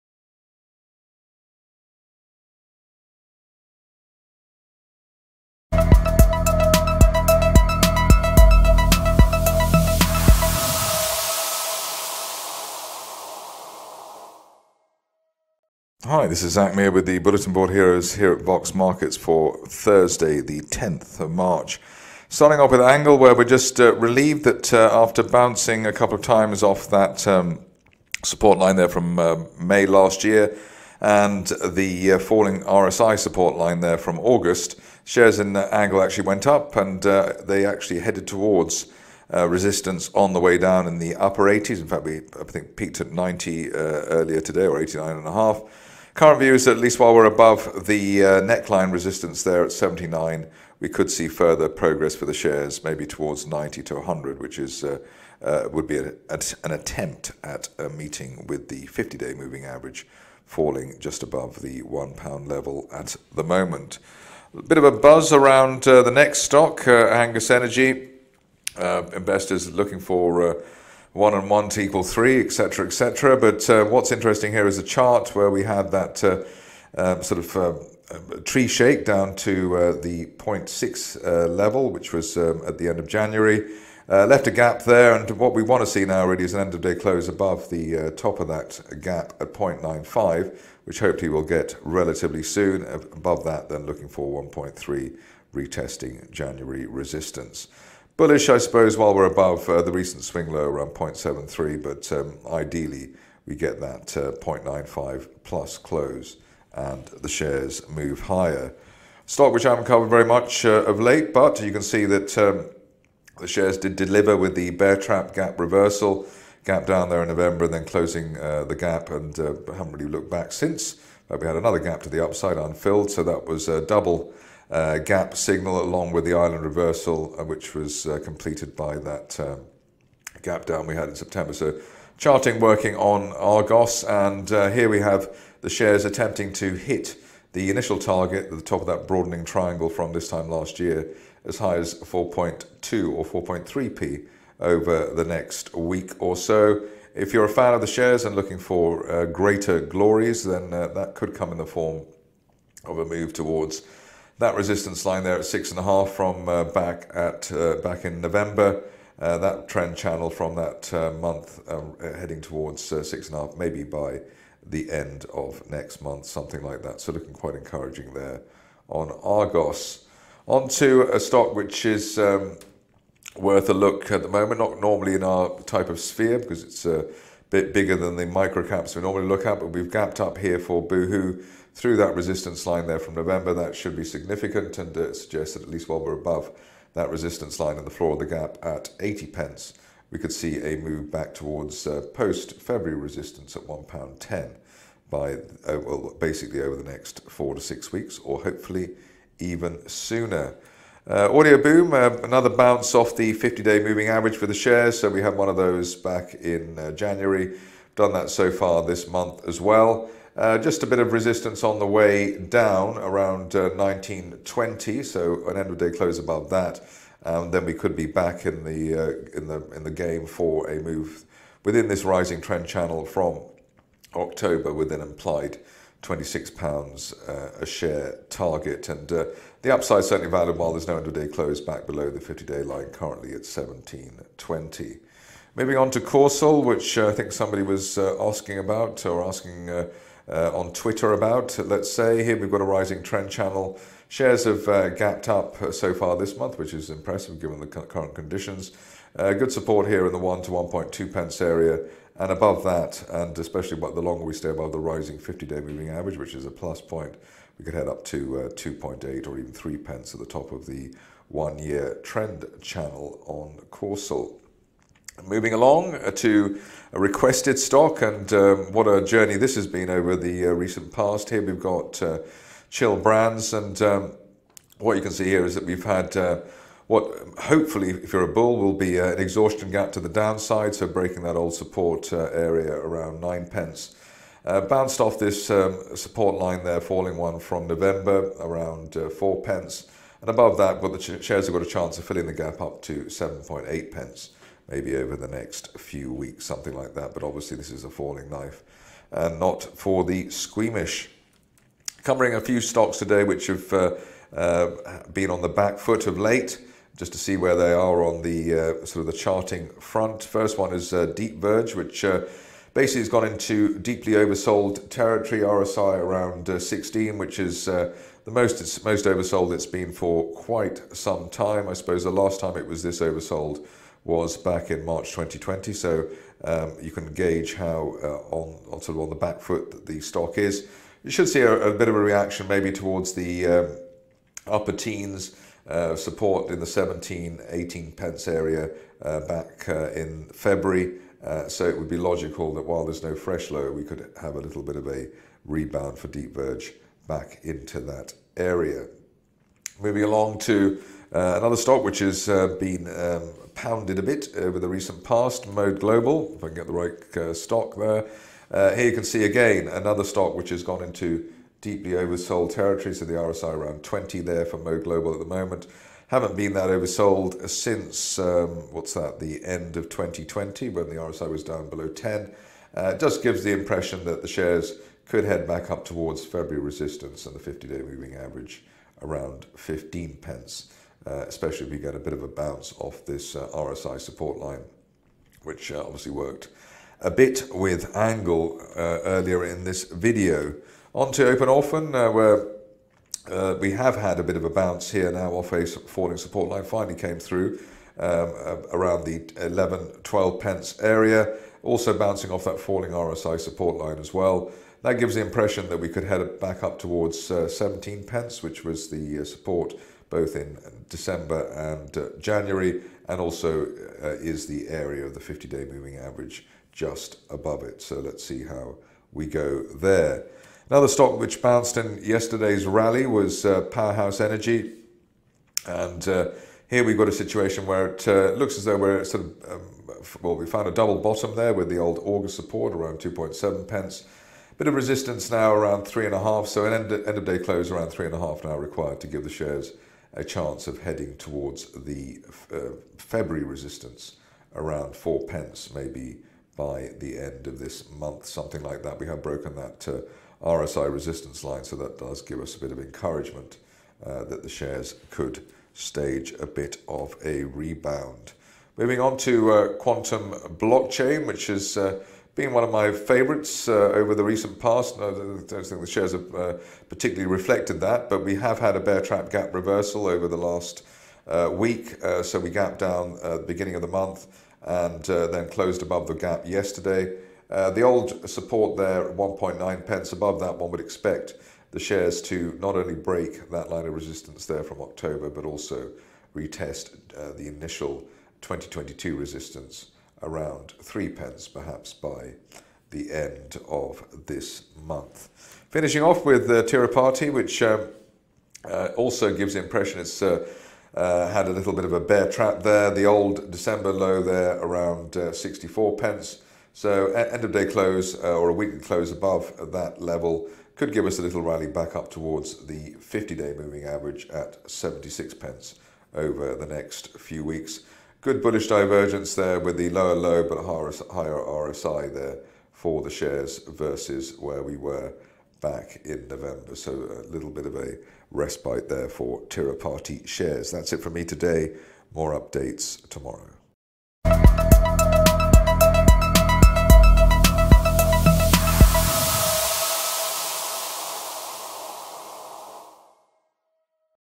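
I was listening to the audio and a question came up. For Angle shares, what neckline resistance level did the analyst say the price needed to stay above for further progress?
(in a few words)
79.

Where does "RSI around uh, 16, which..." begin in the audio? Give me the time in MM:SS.
05:15.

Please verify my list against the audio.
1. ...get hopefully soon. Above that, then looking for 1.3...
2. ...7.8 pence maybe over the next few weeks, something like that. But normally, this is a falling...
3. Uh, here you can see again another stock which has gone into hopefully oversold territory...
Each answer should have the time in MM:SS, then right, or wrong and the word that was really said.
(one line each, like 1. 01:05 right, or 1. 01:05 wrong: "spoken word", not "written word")
1. 01:31 wrong: "relatively", not "hopefully"
2. 04:53 wrong: "obviously", not "normally"
3. 05:58 wrong: "deeply", not "hopefully".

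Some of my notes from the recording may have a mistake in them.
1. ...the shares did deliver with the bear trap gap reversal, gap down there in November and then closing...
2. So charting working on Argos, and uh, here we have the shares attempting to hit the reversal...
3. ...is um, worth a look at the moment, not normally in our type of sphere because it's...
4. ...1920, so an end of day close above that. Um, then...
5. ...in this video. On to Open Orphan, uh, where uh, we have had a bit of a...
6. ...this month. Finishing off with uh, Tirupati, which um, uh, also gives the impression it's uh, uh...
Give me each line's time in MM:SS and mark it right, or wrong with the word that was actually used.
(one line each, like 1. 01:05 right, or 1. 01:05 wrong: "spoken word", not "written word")
1. 01:53 right
2. 02:11 wrong: "initial", not "reversal"
3. 02:51 right
4. 03:33 right
5. 06:29 right
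6. 08:14 right.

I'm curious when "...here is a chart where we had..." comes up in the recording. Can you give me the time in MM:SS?
01:14.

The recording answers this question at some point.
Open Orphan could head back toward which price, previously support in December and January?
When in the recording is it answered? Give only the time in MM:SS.
06:47.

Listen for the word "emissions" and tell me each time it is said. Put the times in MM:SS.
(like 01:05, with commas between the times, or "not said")
not said.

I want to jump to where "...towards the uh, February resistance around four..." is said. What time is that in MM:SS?
07:21.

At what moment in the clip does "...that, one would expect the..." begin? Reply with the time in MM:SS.
08:00.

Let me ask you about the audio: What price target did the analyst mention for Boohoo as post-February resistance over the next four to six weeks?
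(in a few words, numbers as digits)
£1.10.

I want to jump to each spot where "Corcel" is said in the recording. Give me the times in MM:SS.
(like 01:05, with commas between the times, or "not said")
03:55, 04:23.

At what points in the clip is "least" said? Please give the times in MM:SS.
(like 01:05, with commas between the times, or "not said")
00:46, 03:05.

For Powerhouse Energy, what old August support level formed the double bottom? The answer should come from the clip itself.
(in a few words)
2.7 pence.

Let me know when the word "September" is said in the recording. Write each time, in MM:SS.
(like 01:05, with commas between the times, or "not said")
02:11.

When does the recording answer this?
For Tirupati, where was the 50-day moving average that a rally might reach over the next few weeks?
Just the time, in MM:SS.
08:34.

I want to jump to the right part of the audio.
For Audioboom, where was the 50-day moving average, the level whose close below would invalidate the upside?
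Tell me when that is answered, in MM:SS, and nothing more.
03:53.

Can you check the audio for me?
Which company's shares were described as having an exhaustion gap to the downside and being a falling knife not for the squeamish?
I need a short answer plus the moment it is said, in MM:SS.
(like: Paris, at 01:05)
Chill Brands, at 04:32.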